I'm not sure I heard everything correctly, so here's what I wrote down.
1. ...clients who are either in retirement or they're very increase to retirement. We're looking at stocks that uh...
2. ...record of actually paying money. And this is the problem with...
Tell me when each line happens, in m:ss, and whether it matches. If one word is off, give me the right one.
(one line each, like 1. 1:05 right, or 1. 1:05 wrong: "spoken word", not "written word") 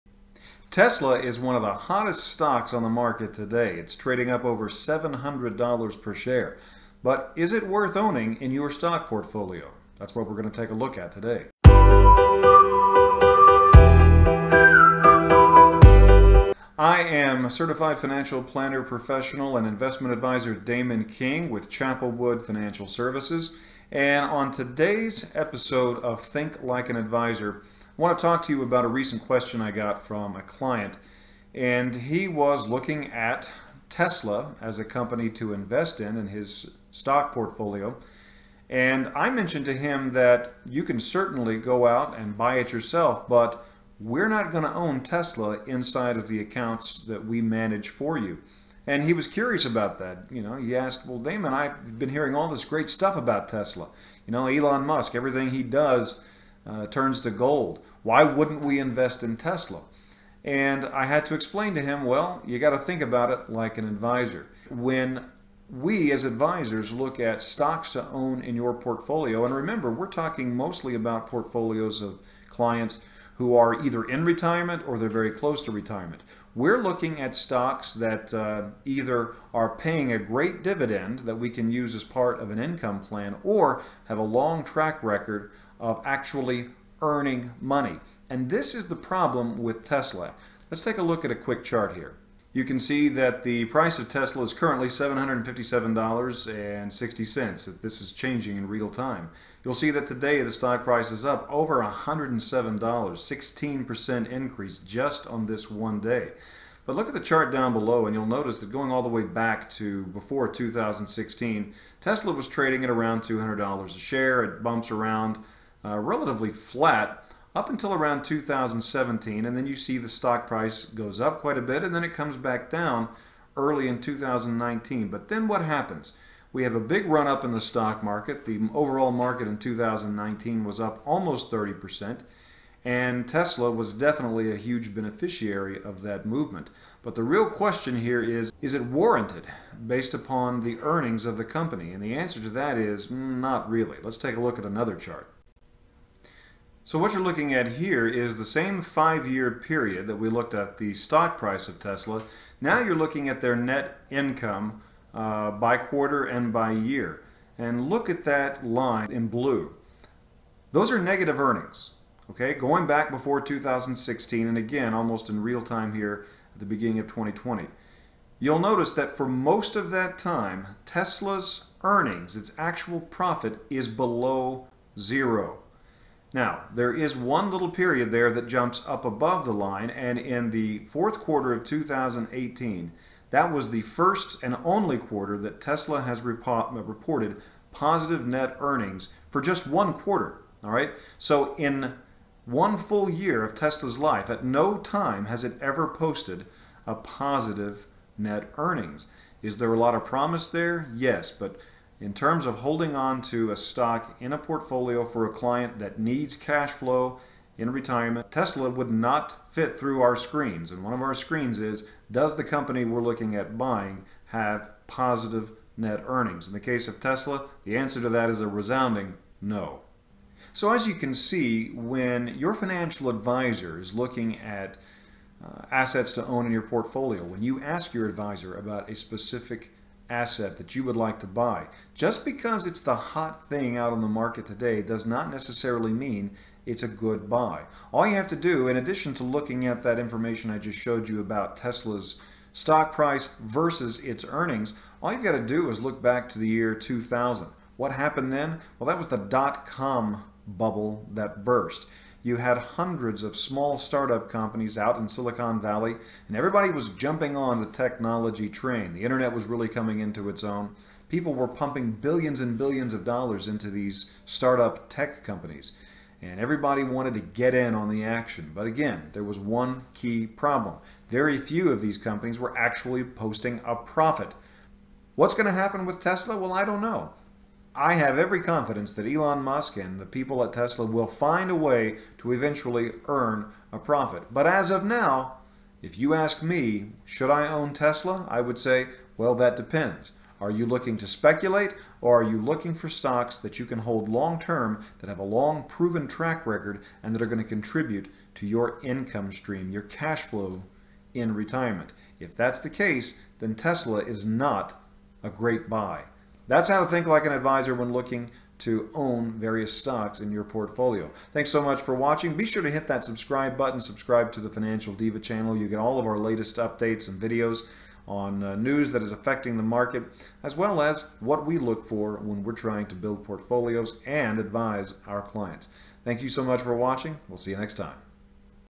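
1. 1:12 wrong: "close", not "increase"
2. 1:25 wrong: "earning", not "paying".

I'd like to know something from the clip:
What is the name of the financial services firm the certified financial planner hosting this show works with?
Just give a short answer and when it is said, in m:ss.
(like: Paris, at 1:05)
Chapelwood Financial Services, at 0:21.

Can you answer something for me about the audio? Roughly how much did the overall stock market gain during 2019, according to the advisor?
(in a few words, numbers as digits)
almost 30%.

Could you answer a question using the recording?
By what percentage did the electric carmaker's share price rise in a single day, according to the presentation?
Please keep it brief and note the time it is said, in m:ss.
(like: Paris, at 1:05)
16%, at 1:42.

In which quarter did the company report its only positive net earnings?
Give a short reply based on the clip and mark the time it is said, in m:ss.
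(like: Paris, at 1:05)
fourth quarter of 2018, at 3:00.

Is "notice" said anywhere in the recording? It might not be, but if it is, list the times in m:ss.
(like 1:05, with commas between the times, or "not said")
1:48, 2:48.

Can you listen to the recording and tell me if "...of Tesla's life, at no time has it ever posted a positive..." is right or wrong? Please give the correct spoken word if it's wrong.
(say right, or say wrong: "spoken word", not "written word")
right.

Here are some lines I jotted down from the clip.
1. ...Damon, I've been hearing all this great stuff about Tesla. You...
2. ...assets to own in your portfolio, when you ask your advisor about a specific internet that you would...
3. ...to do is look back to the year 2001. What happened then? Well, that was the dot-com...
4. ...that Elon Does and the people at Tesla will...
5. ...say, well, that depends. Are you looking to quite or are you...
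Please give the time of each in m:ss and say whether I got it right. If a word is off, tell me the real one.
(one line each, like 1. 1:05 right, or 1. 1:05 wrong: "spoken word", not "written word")
1. 0:51 right
2. 3:45 wrong: "asset", not "internet"
3. 4:05 wrong: "2000", not "2001"
4. 4:38 wrong: "Musk", not "Does"
5. 4:48 wrong: "speculate", not "quite".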